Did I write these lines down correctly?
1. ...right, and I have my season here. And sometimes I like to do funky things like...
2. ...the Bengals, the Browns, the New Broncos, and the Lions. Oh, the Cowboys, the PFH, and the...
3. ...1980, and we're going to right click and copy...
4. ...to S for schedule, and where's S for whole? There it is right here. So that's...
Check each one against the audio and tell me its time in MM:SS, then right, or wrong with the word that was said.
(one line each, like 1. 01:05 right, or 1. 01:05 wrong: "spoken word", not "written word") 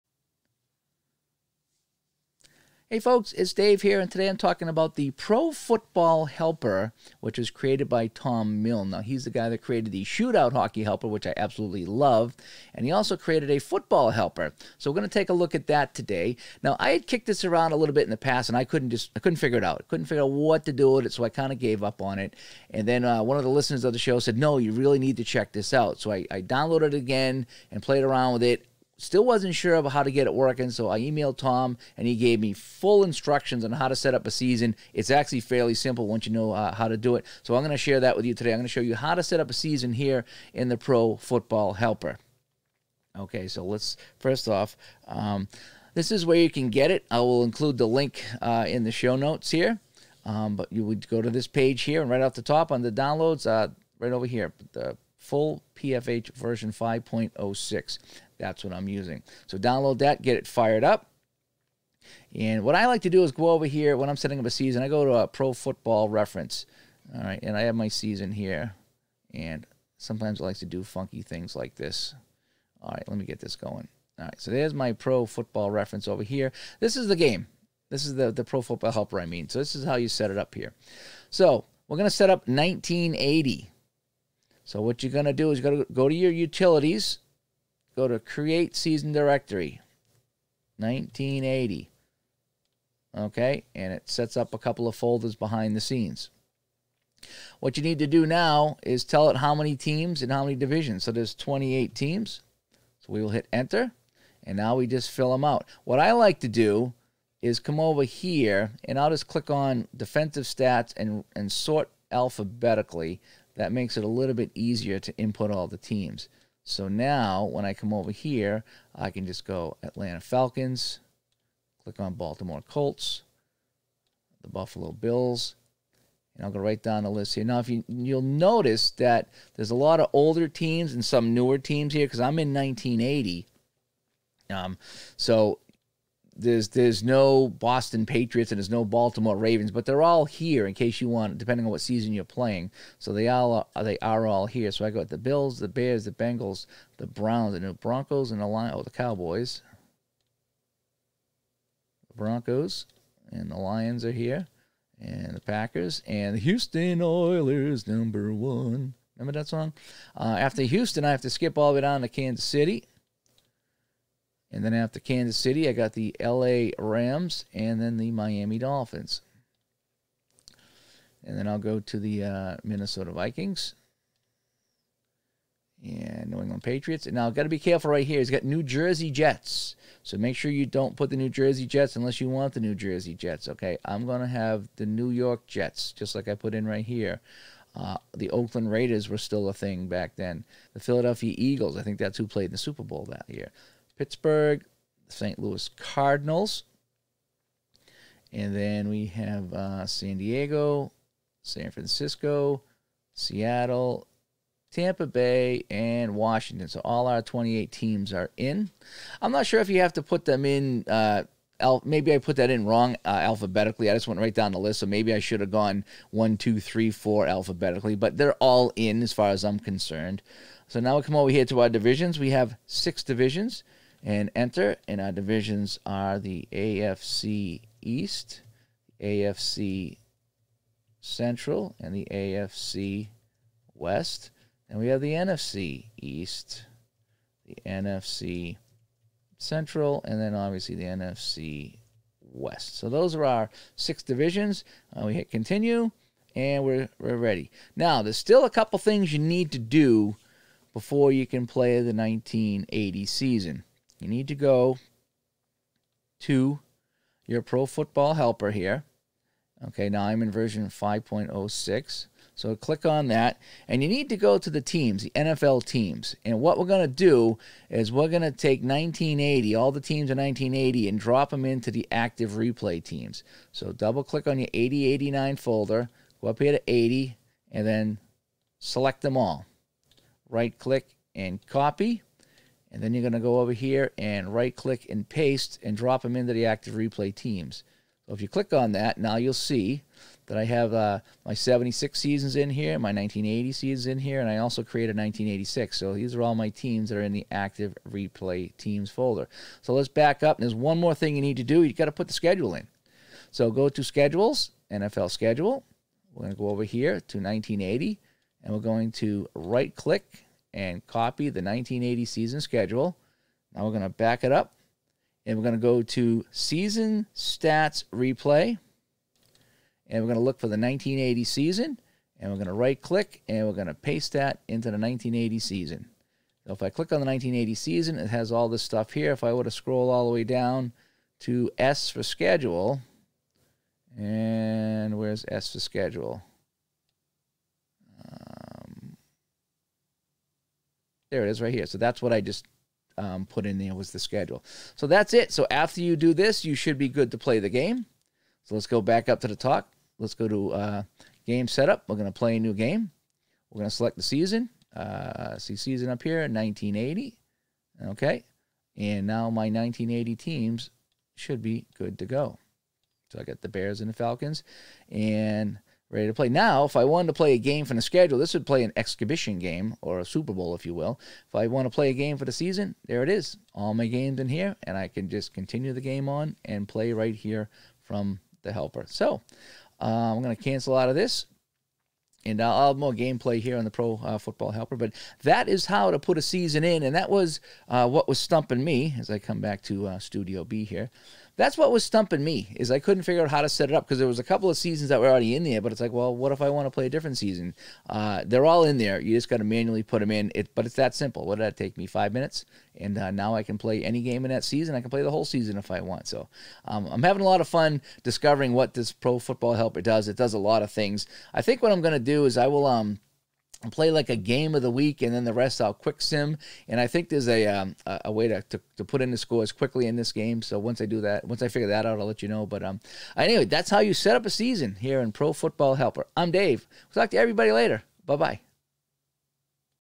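1. 01:07 right
2. 02:26 wrong: "Broncos", not "PFH"
3. 05:07 right
4. 05:31 wrong: "schedule", not "whole".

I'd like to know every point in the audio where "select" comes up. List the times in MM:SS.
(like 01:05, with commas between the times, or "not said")
04:38, 05:53.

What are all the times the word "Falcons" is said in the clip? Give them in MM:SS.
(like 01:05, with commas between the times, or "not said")
02:00, 06:03.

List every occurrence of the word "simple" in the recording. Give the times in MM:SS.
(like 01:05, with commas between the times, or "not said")
00:35, 06:40.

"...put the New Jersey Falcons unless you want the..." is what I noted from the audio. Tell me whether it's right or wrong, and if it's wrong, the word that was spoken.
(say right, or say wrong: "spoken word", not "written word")
wrong: "Jets", not "Falcons".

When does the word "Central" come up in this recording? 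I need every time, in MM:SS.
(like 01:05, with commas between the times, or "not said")
03:50, 03:59.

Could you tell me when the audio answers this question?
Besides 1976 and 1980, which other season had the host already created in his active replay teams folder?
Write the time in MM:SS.
04:54.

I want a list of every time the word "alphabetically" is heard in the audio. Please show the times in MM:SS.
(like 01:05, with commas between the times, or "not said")
01:52, 03:33, 03:37.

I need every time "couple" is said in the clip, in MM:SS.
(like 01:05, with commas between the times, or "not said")
01:34, 04:08, 06:34.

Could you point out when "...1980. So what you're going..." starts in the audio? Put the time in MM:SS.
01:22.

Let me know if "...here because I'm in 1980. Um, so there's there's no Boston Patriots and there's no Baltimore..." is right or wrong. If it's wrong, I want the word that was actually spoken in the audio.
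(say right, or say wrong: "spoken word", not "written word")
right.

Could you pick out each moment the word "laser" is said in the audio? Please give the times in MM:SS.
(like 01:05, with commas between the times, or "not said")
not said.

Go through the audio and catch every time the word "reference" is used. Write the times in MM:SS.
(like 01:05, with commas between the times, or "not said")
01:06, 01:15.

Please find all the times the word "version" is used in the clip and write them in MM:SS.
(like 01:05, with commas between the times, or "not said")
00:56, 04:20.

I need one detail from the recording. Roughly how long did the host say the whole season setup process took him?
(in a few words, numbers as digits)
Five minutes.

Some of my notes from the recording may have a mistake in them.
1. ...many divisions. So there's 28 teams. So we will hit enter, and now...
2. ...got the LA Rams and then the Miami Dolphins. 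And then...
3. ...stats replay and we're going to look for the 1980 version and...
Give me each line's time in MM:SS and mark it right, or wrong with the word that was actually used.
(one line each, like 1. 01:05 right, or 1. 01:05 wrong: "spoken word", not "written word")
1. 01:40 right
2. 02:45 right
3. 05:17 wrong: "season", not "version".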